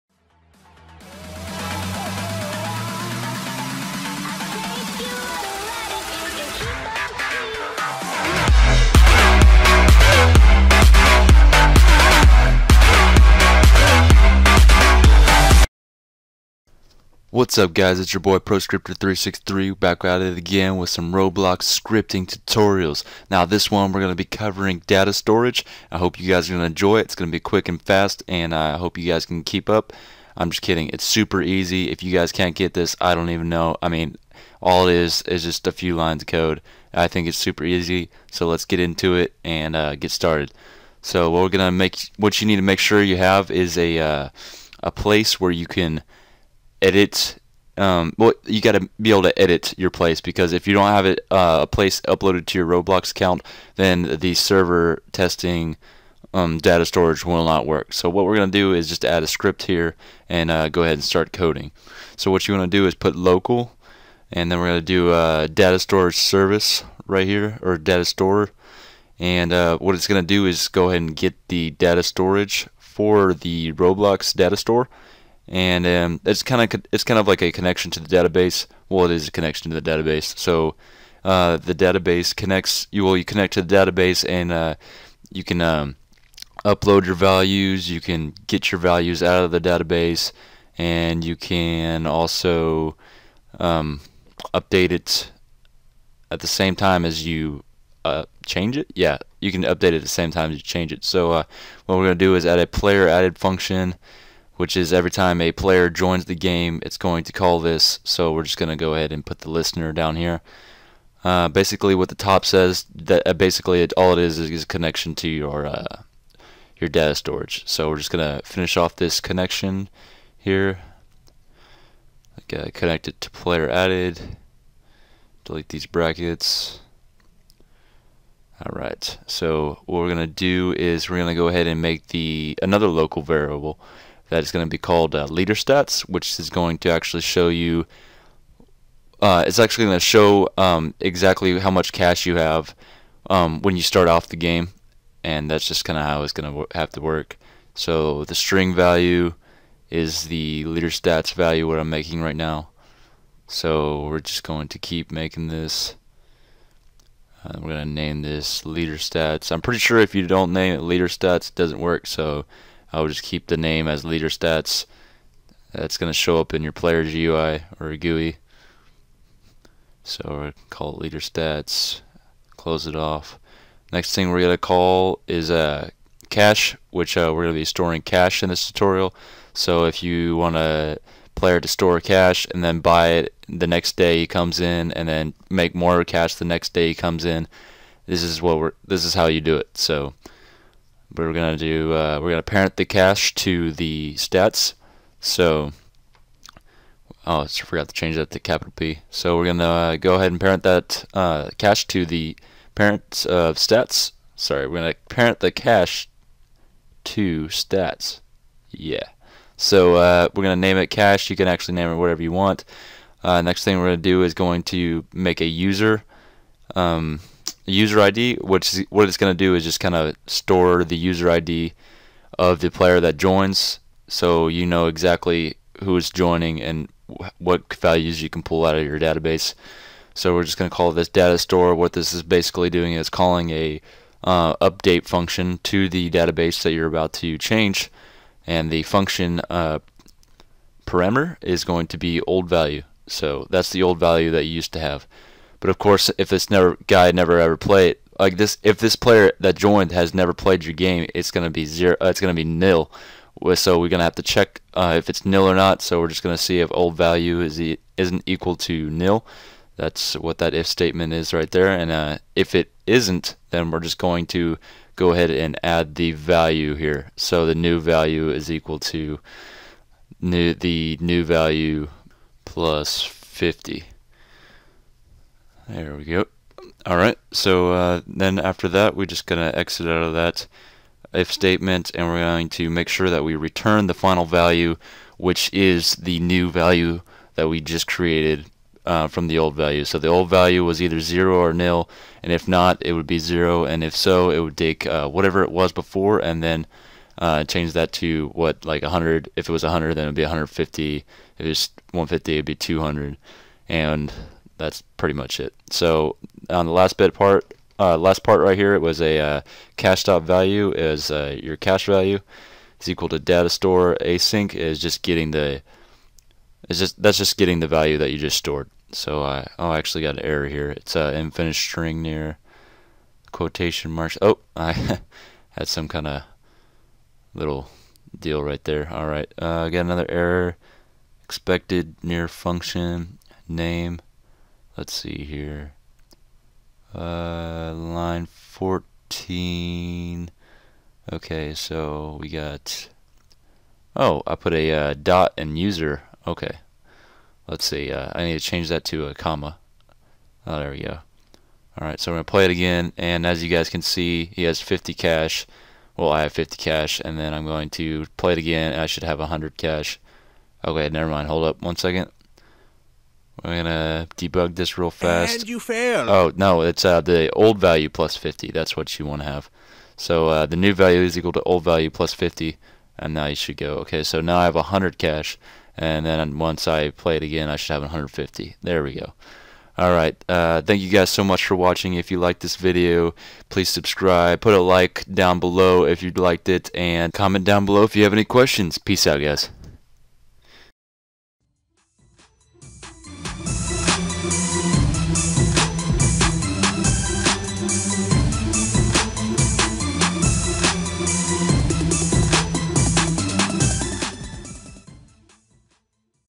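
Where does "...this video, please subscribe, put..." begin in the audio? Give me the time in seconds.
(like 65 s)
382 s.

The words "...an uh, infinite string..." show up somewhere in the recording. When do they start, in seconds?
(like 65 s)
320 s.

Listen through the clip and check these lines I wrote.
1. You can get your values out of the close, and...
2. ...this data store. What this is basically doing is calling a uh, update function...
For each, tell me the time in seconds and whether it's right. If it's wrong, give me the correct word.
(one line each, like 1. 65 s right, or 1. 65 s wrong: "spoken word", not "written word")
1. 87 s wrong: "database", not "close"
2. 230 s right.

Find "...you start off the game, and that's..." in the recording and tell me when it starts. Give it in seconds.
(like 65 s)
143 s.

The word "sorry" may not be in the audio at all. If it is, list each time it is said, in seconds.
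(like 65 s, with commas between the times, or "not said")
204 s.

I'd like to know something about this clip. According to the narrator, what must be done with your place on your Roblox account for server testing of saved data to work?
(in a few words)
uploaded.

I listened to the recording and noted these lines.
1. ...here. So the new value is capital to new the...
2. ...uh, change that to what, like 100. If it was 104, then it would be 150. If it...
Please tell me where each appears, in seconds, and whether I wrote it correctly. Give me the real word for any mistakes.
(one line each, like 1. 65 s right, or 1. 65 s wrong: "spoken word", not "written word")
1. 266 s wrong: "equal", not "capital"
2. 297 s wrong: "100", not "104".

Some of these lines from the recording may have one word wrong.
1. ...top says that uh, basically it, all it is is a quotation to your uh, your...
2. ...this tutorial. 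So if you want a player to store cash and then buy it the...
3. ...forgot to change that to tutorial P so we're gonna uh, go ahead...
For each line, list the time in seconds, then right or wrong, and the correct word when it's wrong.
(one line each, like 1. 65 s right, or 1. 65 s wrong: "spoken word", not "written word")
1. 112 s wrong: "connection", not "quotation"
2. 178 s right
3. 197 s wrong: "capital", not "tutorial".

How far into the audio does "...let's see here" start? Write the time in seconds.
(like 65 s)
334 s.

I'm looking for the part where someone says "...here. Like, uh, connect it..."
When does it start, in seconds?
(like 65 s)
120 s.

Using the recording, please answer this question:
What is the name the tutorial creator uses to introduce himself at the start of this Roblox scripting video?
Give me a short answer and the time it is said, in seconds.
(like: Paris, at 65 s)
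ProScriptor363, at 18 s.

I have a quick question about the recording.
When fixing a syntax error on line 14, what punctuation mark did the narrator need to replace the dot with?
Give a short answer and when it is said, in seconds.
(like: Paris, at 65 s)
comma, at 349 s.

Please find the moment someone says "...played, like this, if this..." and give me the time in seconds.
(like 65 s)
247 s.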